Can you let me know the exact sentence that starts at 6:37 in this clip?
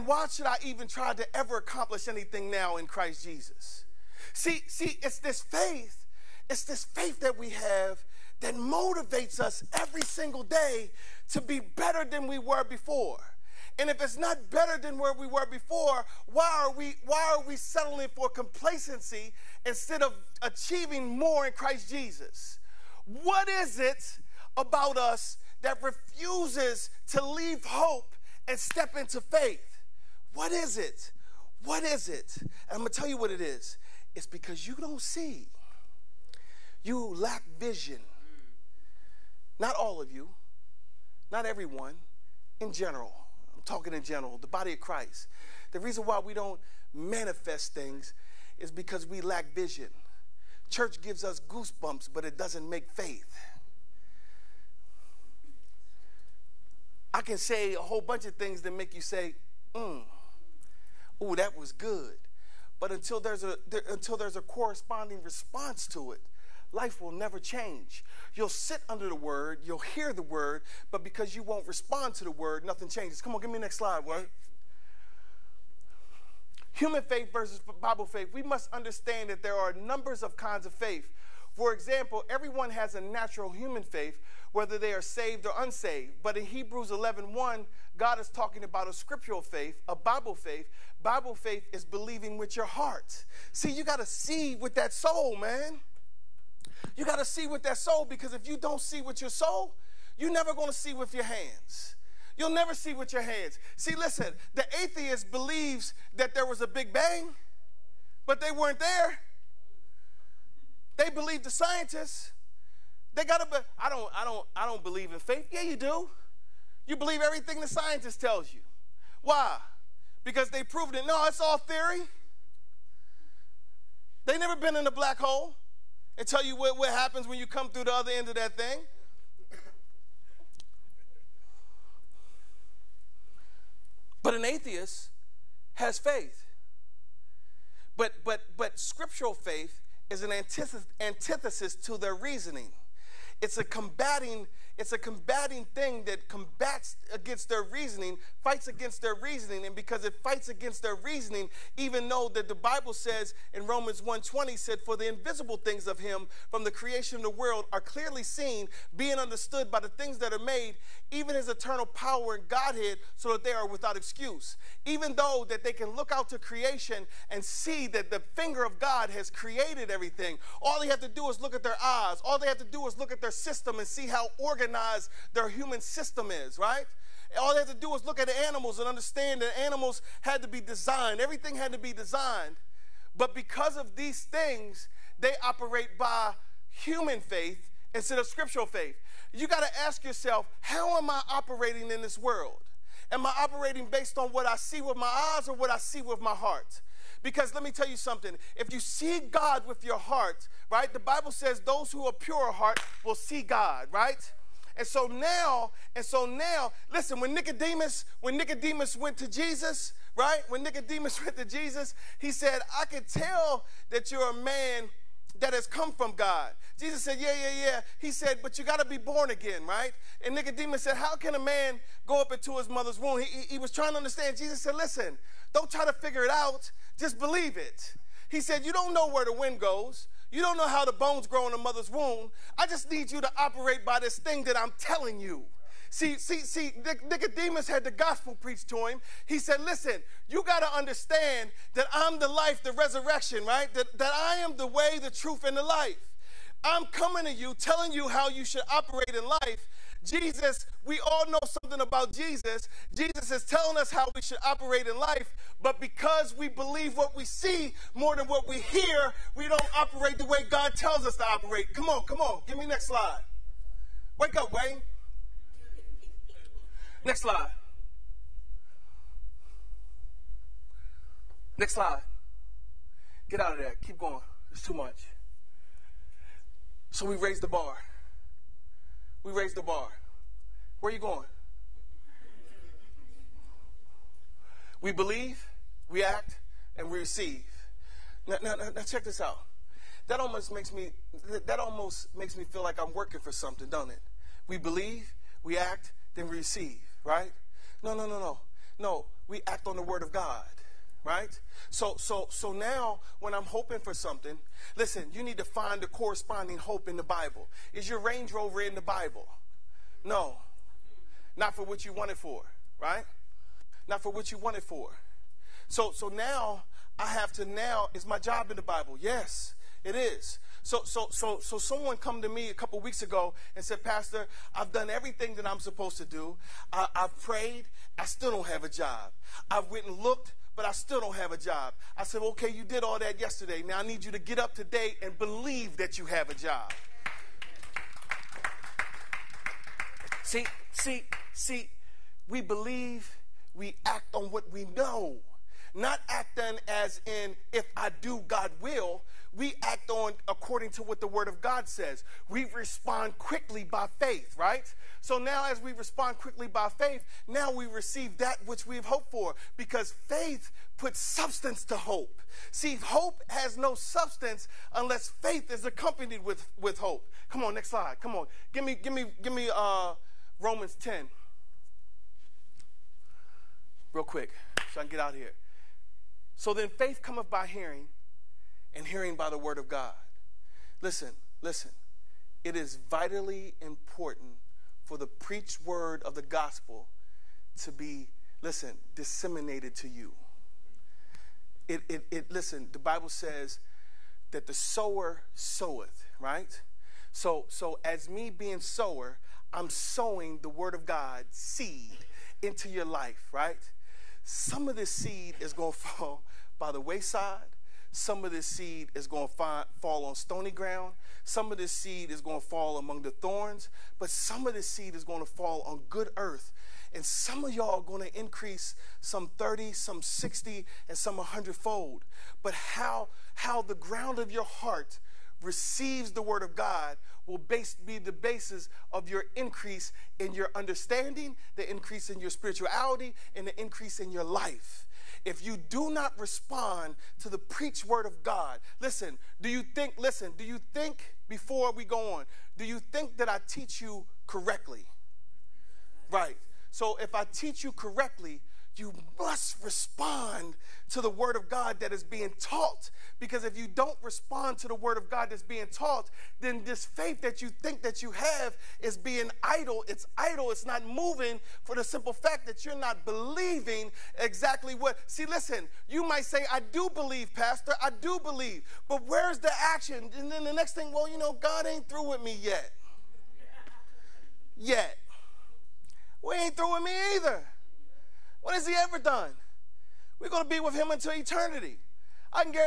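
So, so as me being sower, I'm sowing the word of God seed into your life, right?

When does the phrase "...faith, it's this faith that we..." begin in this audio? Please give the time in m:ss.
0:05.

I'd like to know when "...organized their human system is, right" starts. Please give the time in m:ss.
2:54.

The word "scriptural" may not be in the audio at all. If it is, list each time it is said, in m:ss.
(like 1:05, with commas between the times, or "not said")
1:28, 2:18, 3:08.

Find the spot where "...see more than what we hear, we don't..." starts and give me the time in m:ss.
4:17.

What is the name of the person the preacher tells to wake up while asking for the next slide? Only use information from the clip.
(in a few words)
Wayne.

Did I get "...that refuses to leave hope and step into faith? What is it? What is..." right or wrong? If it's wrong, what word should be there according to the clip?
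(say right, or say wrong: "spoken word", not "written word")
right.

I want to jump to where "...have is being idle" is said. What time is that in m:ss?
7:38.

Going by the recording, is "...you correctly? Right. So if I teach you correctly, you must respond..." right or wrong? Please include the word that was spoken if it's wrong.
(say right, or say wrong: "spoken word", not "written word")
right.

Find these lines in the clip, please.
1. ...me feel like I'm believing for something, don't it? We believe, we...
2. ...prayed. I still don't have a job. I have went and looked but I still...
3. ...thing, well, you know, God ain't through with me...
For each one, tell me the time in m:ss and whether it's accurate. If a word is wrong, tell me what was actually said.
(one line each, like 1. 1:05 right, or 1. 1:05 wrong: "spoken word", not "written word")
1. 4:52 wrong: "working", not "believing"
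2. 5:27 right
3. 7:50 right.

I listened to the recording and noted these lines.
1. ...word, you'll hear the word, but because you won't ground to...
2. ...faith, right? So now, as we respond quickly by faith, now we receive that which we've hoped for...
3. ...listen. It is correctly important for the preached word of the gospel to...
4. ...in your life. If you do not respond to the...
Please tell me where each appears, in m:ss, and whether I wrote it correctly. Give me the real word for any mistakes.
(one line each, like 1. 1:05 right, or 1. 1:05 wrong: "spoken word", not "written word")
1. 1:09 wrong: "respond", not "ground"
2. 5:53 right
3. 6:21 wrong: "vitally", not "correctly"
4. 7:13 right.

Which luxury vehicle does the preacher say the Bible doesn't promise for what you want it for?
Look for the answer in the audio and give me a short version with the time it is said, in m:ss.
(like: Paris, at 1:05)
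Range Rover, at 5:07.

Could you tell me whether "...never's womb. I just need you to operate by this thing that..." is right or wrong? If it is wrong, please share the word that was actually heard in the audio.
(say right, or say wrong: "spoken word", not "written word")
wrong: "mother", not "never".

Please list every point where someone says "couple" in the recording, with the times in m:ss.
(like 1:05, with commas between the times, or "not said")
5:22.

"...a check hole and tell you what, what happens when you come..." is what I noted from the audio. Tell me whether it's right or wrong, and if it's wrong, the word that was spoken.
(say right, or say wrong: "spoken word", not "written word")
wrong: "black", not "check".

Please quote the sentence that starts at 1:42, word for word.
You'll never see with your hands.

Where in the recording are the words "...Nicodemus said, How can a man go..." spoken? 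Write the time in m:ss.
3:40.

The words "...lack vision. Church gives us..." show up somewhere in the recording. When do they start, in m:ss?
0:49.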